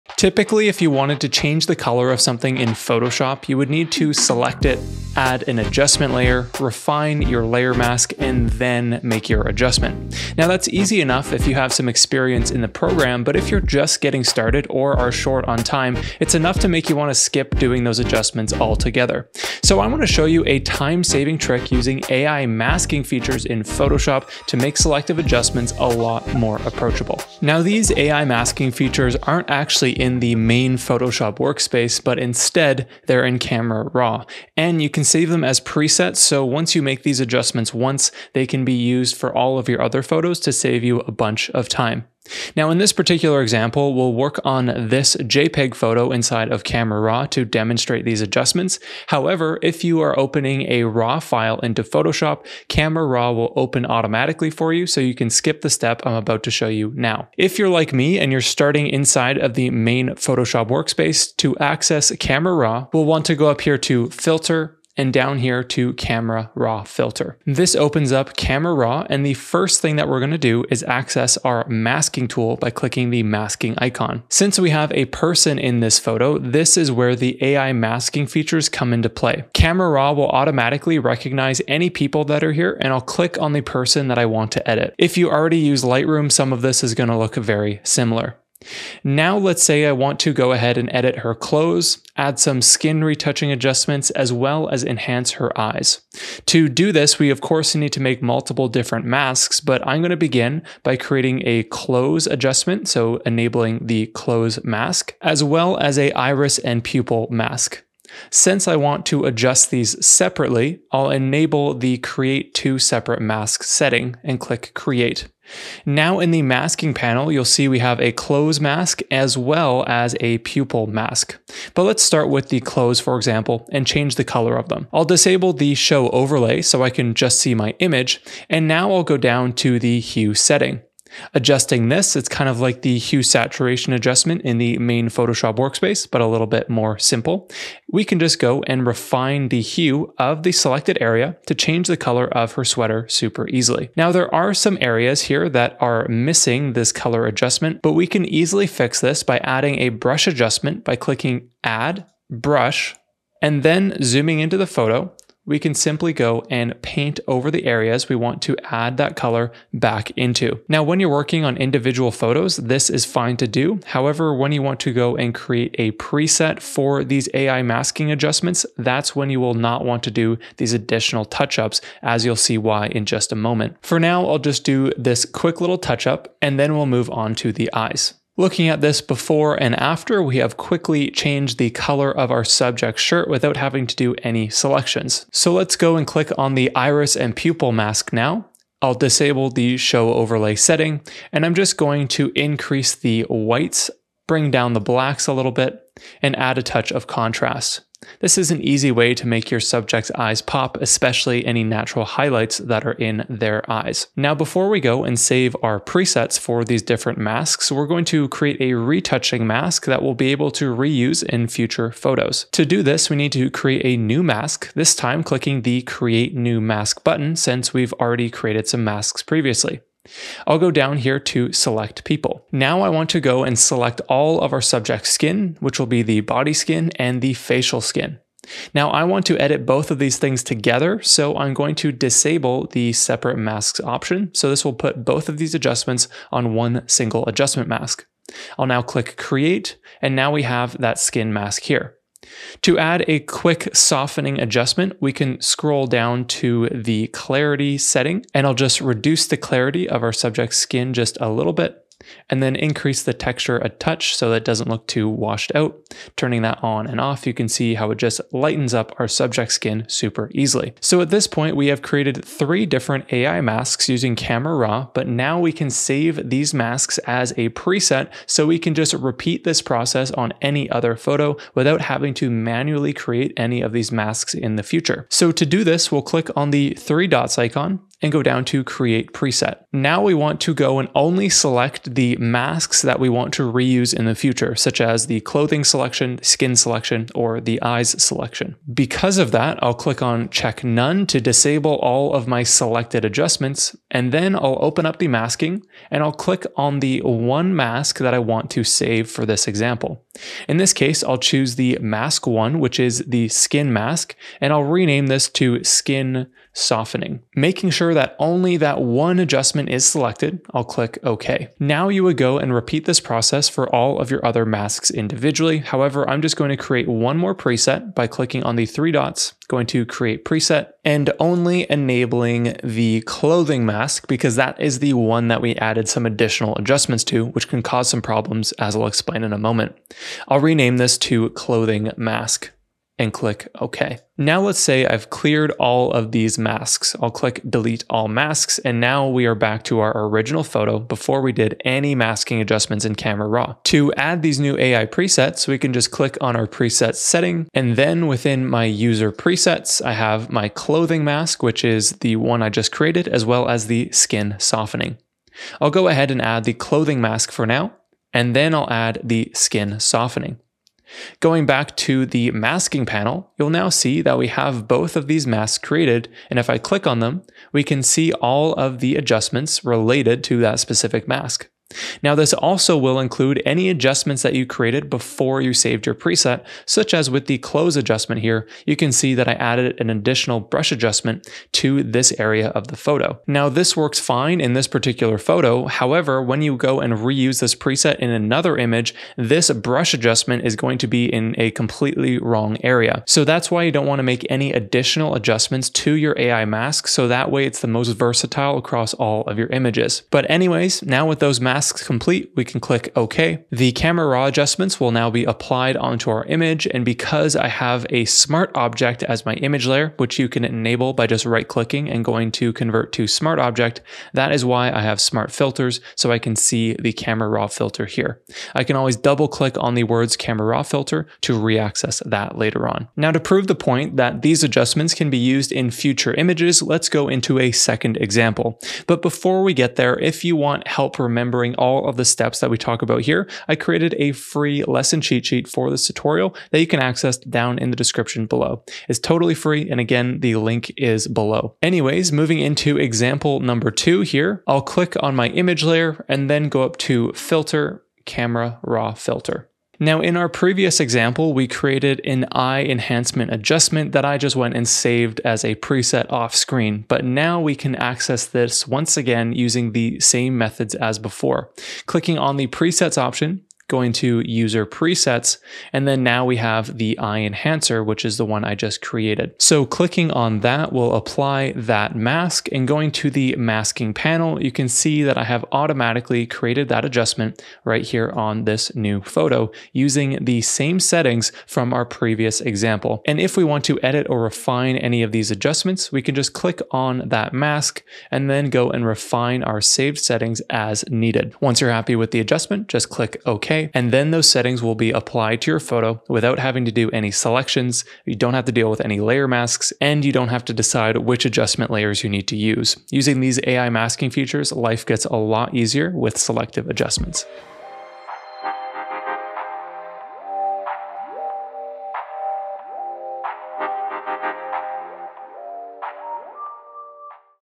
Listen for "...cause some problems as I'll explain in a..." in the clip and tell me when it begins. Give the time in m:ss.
5:27.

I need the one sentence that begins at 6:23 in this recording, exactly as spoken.
Now, this works fine in this particular photo.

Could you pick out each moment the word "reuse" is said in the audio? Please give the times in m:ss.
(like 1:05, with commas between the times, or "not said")
3:30, 4:43, 6:26.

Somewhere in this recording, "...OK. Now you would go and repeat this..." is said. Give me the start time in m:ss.
5:11.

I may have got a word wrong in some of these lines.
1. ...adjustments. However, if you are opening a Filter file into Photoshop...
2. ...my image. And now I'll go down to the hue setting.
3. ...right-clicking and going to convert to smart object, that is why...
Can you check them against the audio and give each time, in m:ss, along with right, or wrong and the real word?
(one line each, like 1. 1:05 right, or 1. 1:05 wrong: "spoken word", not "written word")
1. 0:48 wrong: "RAW", not "Filter"
2. 2:07 right
3. 6:51 right.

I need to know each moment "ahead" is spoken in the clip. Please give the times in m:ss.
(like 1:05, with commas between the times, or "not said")
1:30, 5:55.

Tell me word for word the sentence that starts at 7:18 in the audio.
It's totally free, and again, the link is below.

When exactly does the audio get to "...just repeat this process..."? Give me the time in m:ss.
4:28.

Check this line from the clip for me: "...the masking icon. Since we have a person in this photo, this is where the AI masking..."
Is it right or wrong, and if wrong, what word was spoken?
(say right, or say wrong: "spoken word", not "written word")
right.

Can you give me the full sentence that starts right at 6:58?
I can always double-click on the words camera raw filter to re-access that later on.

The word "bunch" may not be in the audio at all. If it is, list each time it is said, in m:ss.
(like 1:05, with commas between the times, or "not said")
0:41.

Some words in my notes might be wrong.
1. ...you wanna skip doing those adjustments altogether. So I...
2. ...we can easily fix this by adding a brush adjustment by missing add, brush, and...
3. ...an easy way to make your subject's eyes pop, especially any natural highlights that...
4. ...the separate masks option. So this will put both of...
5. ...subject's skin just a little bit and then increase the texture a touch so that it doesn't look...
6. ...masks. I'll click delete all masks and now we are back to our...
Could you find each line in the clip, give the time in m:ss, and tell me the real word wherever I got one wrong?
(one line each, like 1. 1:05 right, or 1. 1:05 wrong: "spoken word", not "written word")
1. 0:16 right
2. 2:27 wrong: "clicking", not "missing"
3. 3:18 right
4. 3:52 right
5. 4:10 right
6. 5:36 right.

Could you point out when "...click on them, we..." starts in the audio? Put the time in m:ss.
6:06.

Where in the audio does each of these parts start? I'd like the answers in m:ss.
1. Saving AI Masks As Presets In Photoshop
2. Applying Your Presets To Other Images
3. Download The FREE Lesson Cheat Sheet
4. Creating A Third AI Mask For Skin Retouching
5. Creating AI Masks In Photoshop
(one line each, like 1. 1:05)
1. 4:25
2. 7:23
3. 7:03
4. 3:31
5. 1:12.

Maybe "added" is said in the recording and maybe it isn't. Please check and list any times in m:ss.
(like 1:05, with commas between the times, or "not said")
5:25, 6:19.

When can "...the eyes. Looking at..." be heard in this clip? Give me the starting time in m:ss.
2:57.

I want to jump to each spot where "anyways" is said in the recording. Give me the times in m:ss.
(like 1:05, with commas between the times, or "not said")
6:40, 7:21.